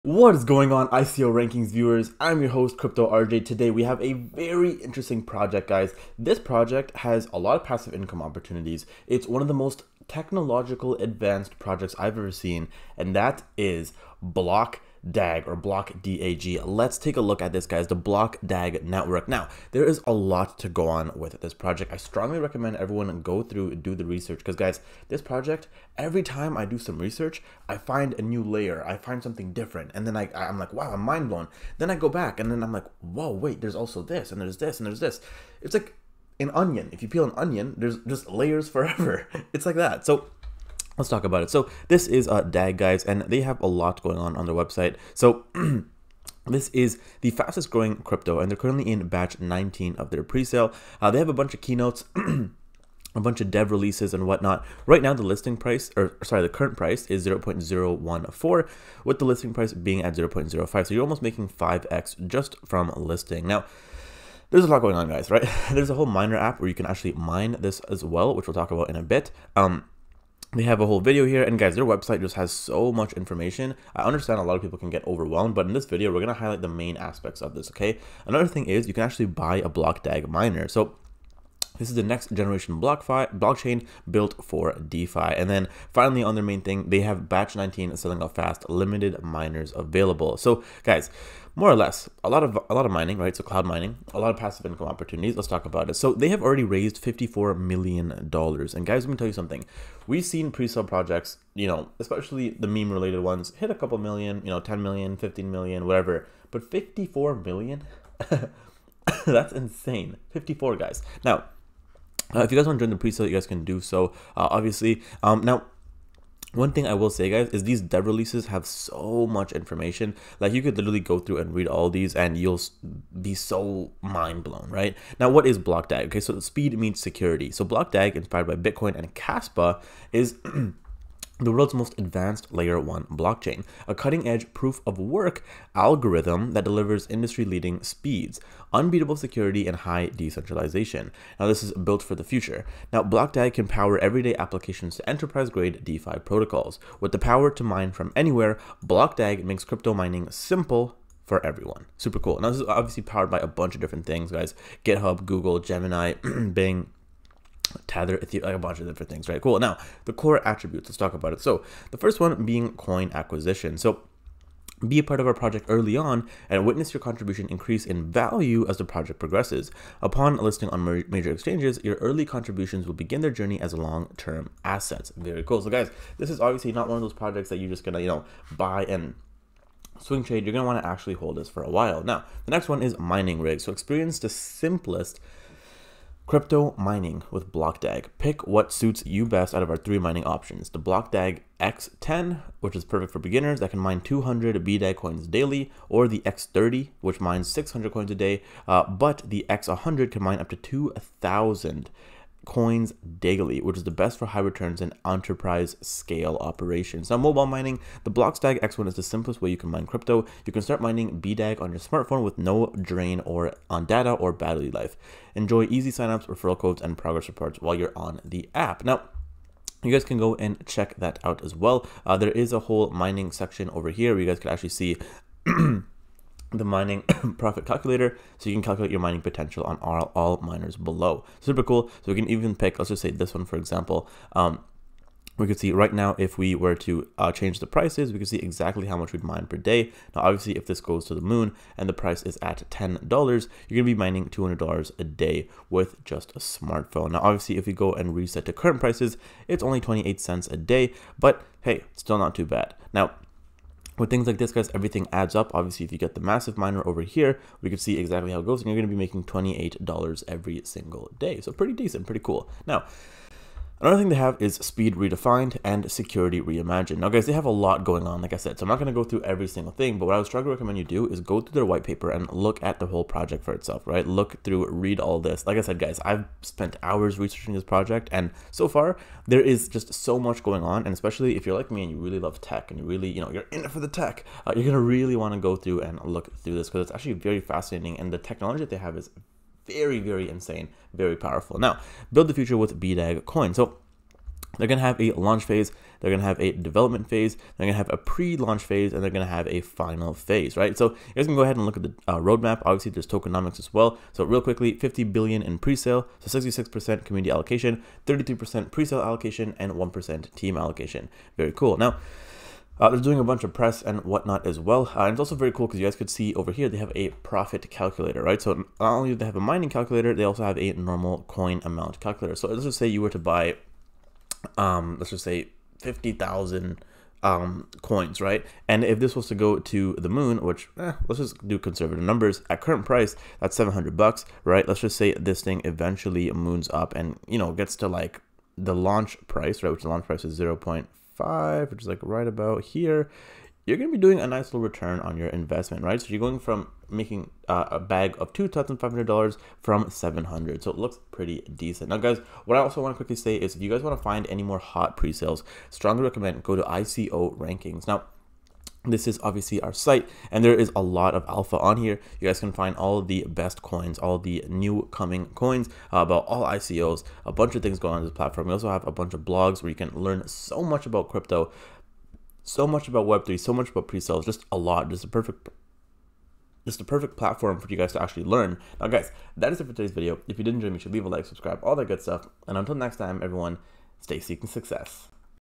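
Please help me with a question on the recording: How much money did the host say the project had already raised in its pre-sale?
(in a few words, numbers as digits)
$54 million.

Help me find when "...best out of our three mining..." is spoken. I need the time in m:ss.
3:09.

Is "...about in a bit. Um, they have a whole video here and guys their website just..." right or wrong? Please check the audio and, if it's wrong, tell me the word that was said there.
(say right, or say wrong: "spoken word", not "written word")
right.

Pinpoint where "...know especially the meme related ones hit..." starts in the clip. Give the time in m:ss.
1:41.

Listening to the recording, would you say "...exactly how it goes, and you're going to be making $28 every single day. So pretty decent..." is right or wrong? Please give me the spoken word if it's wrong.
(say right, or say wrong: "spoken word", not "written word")
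right.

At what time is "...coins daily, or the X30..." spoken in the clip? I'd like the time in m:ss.
3:14.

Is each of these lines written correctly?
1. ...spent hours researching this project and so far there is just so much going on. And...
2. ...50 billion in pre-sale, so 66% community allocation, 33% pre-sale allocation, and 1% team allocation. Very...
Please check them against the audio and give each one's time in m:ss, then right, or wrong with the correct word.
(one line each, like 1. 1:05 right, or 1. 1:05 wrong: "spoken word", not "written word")
1. 4:36 right
2. 5:04 right.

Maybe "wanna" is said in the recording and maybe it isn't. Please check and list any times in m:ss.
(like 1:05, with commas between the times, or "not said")
3:00, 4:45.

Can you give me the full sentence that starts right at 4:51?
Now, build the future with BDAG coin.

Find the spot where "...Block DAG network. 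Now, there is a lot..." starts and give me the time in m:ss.
0:17.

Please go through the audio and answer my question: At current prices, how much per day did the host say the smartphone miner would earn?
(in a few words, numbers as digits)
28 cents.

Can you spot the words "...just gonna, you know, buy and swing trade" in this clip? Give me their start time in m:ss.
2:57.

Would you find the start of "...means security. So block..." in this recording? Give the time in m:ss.
2:06.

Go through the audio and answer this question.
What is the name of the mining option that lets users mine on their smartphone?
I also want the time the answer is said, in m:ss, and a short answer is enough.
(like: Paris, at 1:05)
X1, at 3:28.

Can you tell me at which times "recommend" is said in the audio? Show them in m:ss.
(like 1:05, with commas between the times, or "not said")
0:22, 4:30, 5:56.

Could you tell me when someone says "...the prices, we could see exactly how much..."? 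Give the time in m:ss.
3:57.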